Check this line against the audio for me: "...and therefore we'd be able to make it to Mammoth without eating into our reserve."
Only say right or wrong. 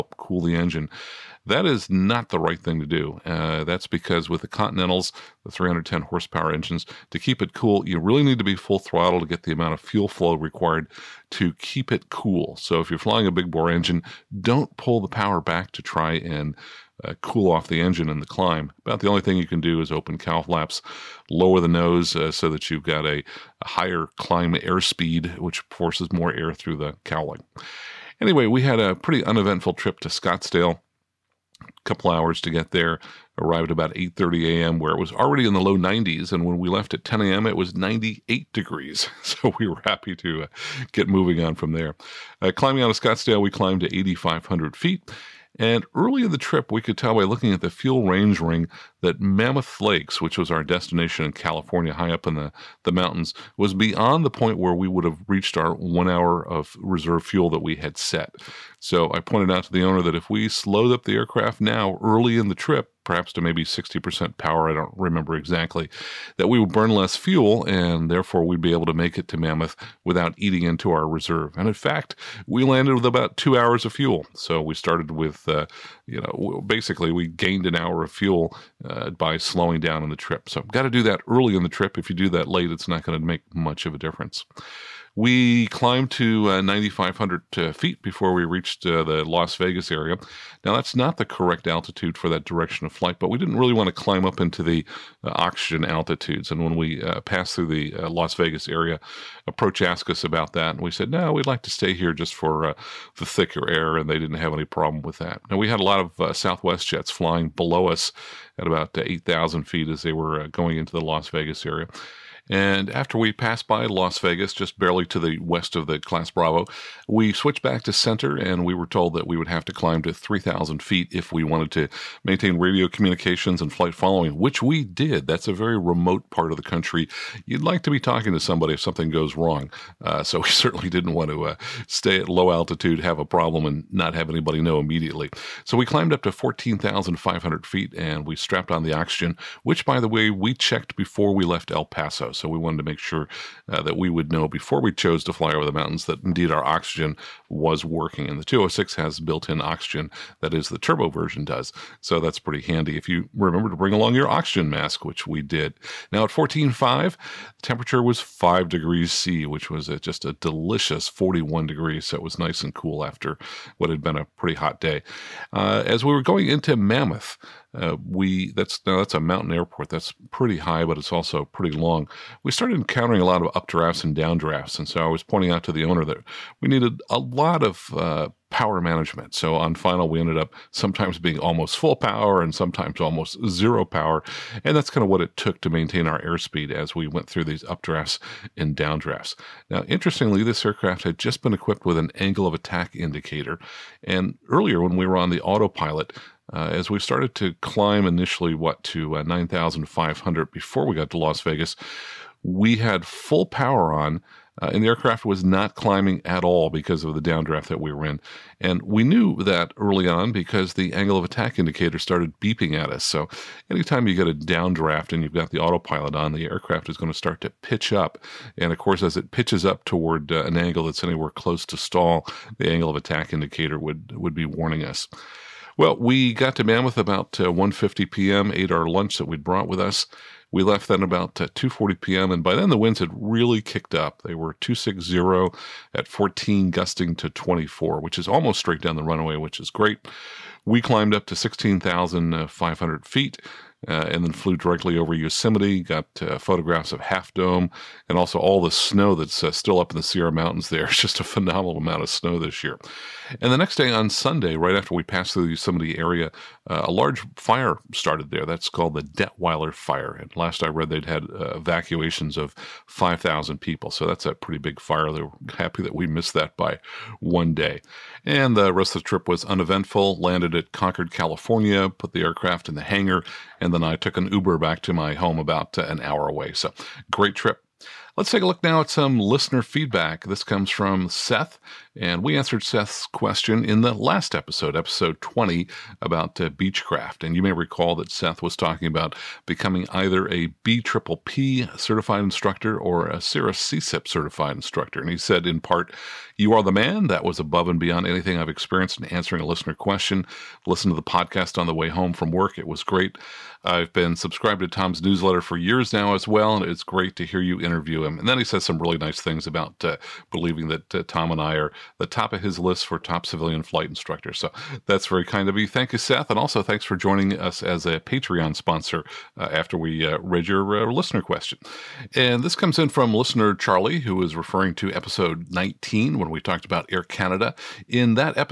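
right.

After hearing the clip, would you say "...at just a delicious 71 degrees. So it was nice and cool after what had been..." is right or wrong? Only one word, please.
wrong.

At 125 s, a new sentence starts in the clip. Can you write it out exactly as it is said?
That's a very remote part of the country.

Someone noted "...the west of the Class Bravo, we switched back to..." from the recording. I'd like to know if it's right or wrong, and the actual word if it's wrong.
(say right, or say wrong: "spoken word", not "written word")
right.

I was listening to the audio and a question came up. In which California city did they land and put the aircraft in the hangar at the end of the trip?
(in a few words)
Concord.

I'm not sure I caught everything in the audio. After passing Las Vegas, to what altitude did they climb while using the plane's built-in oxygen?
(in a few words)
14,500 feet.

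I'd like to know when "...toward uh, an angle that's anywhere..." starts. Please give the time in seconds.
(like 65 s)
219 s.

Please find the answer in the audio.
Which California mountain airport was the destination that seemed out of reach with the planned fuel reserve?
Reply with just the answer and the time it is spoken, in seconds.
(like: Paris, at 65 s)
Mammoth Lakes, at 49 s.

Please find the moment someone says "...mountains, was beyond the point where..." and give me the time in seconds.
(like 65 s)
52 s.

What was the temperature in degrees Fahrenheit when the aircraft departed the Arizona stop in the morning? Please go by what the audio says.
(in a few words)
98 degrees.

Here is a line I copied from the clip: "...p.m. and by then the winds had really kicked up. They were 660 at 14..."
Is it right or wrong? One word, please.
wrong.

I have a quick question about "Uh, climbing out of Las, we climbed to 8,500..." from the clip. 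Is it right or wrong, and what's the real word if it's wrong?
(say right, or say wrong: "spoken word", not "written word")
wrong: "Scottsdale", not "Las".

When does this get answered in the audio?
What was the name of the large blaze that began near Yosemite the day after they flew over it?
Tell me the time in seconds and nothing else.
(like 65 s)
259 s.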